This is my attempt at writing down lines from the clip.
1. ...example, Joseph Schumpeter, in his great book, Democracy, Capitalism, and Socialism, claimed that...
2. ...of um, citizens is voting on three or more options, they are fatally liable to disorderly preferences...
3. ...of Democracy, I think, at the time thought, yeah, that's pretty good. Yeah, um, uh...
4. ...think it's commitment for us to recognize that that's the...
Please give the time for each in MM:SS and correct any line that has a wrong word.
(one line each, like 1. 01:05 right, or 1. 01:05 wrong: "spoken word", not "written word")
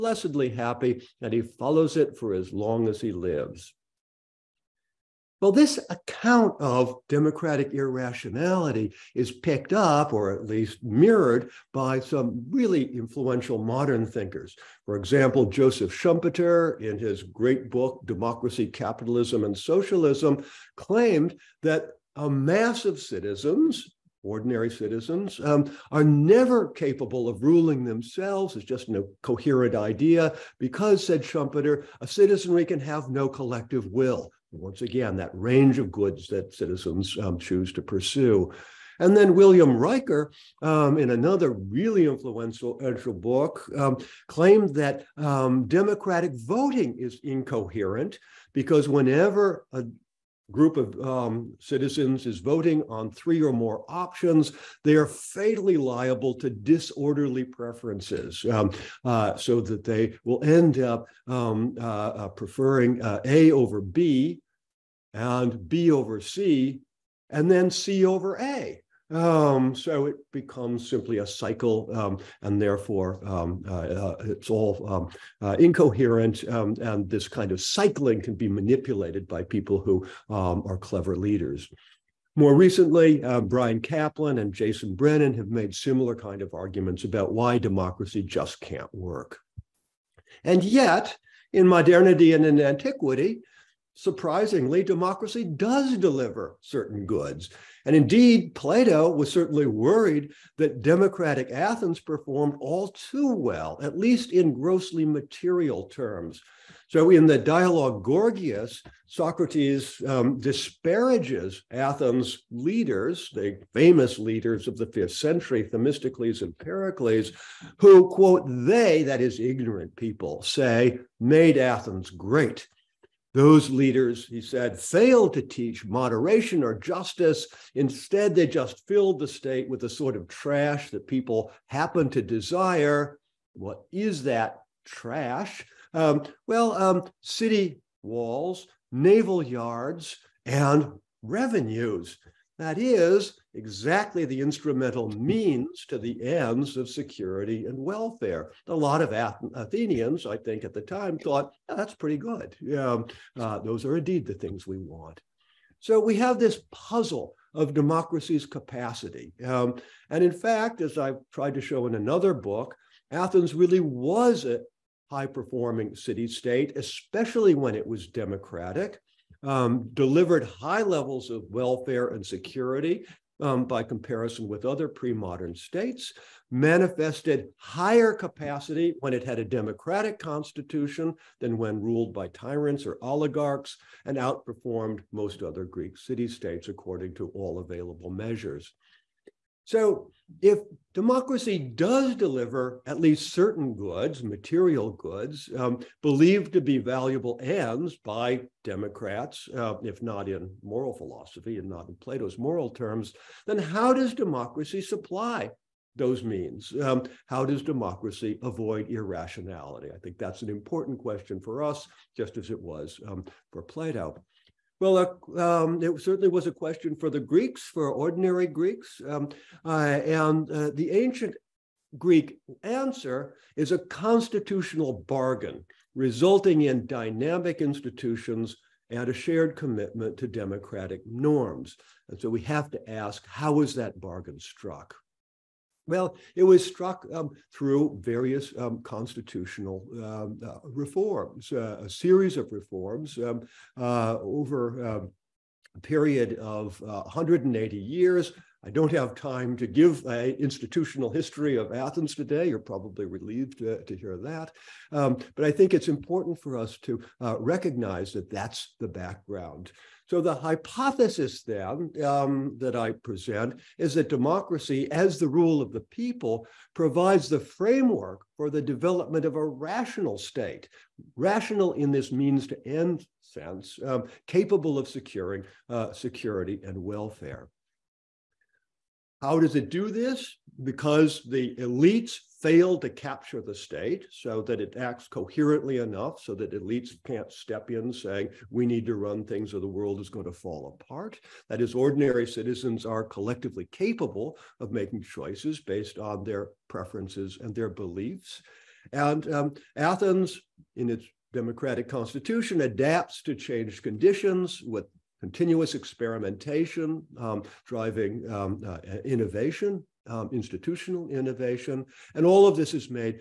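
1. 00:14 right
2. 00:50 right
3. 02:29 wrong: "Athenians", not "Democracy"
4. 04:15 wrong: "important", not "commitment".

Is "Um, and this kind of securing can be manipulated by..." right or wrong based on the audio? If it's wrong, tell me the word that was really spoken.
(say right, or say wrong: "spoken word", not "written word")
wrong: "cycling", not "securing".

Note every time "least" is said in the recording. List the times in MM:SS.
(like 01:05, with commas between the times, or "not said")
00:10, 01:43, 03:12.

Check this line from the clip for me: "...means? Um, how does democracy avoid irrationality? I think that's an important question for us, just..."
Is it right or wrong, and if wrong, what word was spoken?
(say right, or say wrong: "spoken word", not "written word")
right.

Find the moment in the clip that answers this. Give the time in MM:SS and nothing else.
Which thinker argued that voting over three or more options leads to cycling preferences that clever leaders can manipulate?
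00:39.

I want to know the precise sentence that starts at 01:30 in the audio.
And yet, in modernity and in antiquity, surprisingly, democracy does deliver certain goods.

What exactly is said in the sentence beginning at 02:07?
Instead, they just filled the state with the sort of trash that people happen to desire.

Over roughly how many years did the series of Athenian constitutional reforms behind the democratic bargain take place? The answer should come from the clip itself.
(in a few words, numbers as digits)
180.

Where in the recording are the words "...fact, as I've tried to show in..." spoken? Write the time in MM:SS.
02:40.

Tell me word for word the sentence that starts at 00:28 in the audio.
It's just no coherent idea because, said Schumpeter, a citizenry can have no collective will.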